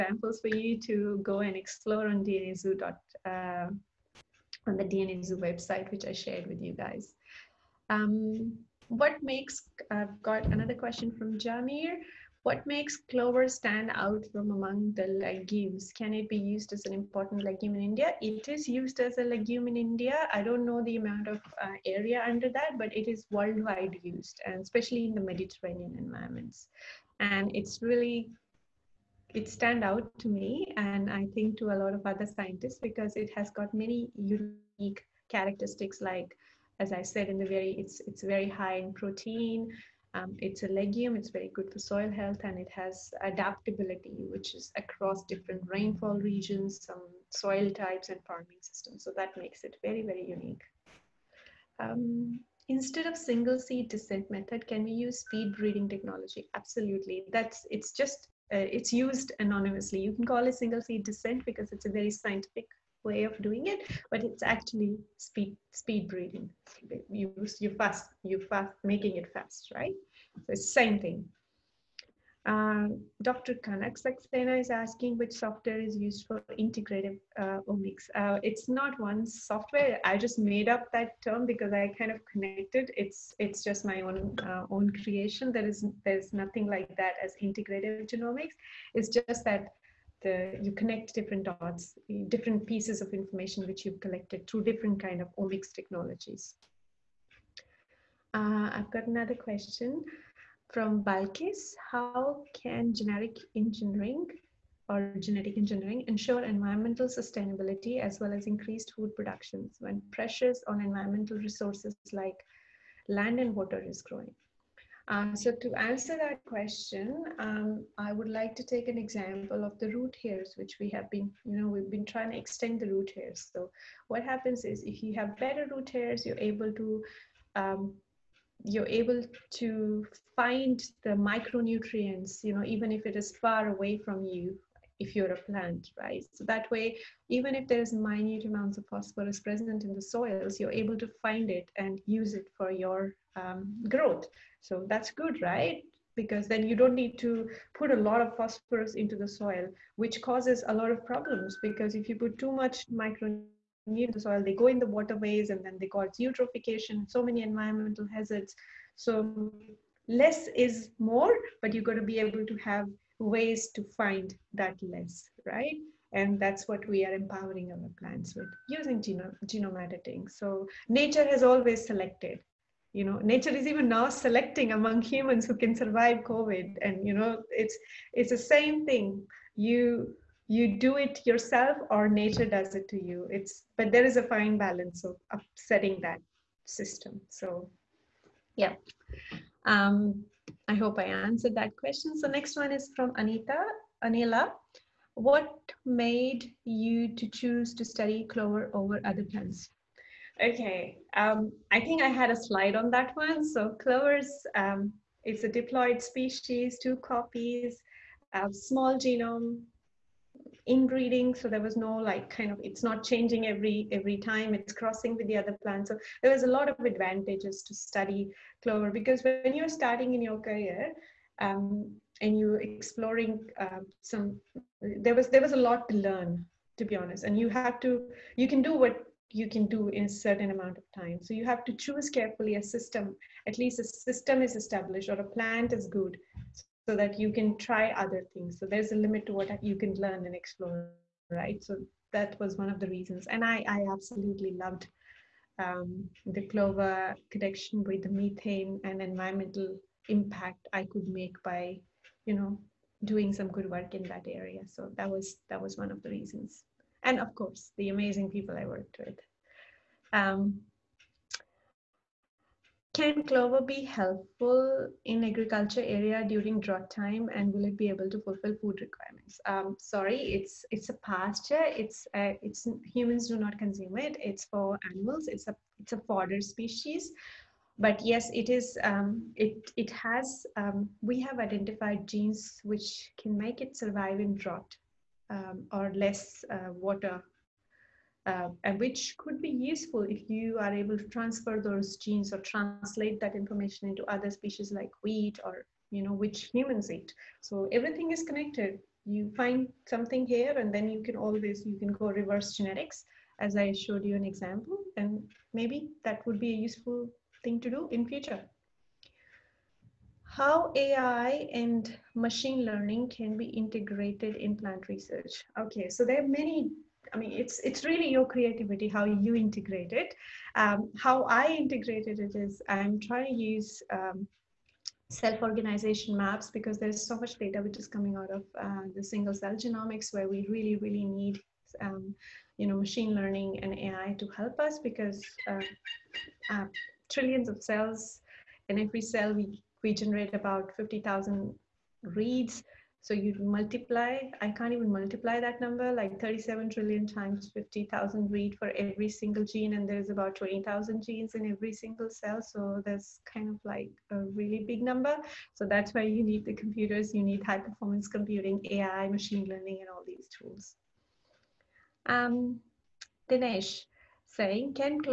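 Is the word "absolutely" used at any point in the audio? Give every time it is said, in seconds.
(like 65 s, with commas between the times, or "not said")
56 s, 243 s.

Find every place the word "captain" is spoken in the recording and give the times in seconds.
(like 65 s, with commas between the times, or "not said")
not said.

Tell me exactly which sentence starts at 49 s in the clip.
So that makes it very, very unique.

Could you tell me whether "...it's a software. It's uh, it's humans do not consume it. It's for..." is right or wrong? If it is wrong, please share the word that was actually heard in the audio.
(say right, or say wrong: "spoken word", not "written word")
wrong: "pasture", not "software".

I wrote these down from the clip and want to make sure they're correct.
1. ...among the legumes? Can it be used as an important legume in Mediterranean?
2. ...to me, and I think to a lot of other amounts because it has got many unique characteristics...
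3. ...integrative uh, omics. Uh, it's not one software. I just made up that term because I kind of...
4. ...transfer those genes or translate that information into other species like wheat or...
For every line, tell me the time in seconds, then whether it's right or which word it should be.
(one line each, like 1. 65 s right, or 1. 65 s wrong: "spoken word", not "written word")
1. 14 s wrong: "India", not "Mediterranean"
2. 30 s wrong: "scientists", not "amounts"
3. 76 s right
4. 291 s right.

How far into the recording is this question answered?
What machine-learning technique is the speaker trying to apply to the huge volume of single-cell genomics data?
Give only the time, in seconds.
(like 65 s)
325 s.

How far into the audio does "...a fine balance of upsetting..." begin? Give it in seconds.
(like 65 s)
184 s.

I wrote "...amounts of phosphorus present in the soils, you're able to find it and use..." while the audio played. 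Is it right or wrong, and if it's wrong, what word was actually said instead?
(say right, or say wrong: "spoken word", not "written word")
right.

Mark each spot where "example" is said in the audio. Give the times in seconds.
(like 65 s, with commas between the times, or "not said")
118 s, 304 s.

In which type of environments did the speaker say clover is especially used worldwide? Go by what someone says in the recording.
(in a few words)
Mediterranean.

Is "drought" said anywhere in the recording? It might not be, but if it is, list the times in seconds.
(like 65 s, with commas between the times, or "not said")
266 s, 284 s.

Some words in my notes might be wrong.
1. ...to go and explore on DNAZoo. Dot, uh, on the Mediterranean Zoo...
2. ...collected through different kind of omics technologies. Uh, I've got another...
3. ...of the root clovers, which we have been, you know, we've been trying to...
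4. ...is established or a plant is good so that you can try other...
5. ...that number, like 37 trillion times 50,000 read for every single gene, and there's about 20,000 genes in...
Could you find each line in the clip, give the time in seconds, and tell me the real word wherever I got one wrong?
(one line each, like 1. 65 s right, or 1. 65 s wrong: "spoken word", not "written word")
1. 0 s wrong: "DNA", not "Mediterranean"
2. 94 s right
3. 119 s wrong: "hairs", not "clovers"
4. 234 s right
5. 345 s right.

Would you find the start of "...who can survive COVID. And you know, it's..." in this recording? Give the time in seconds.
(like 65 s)
175 s.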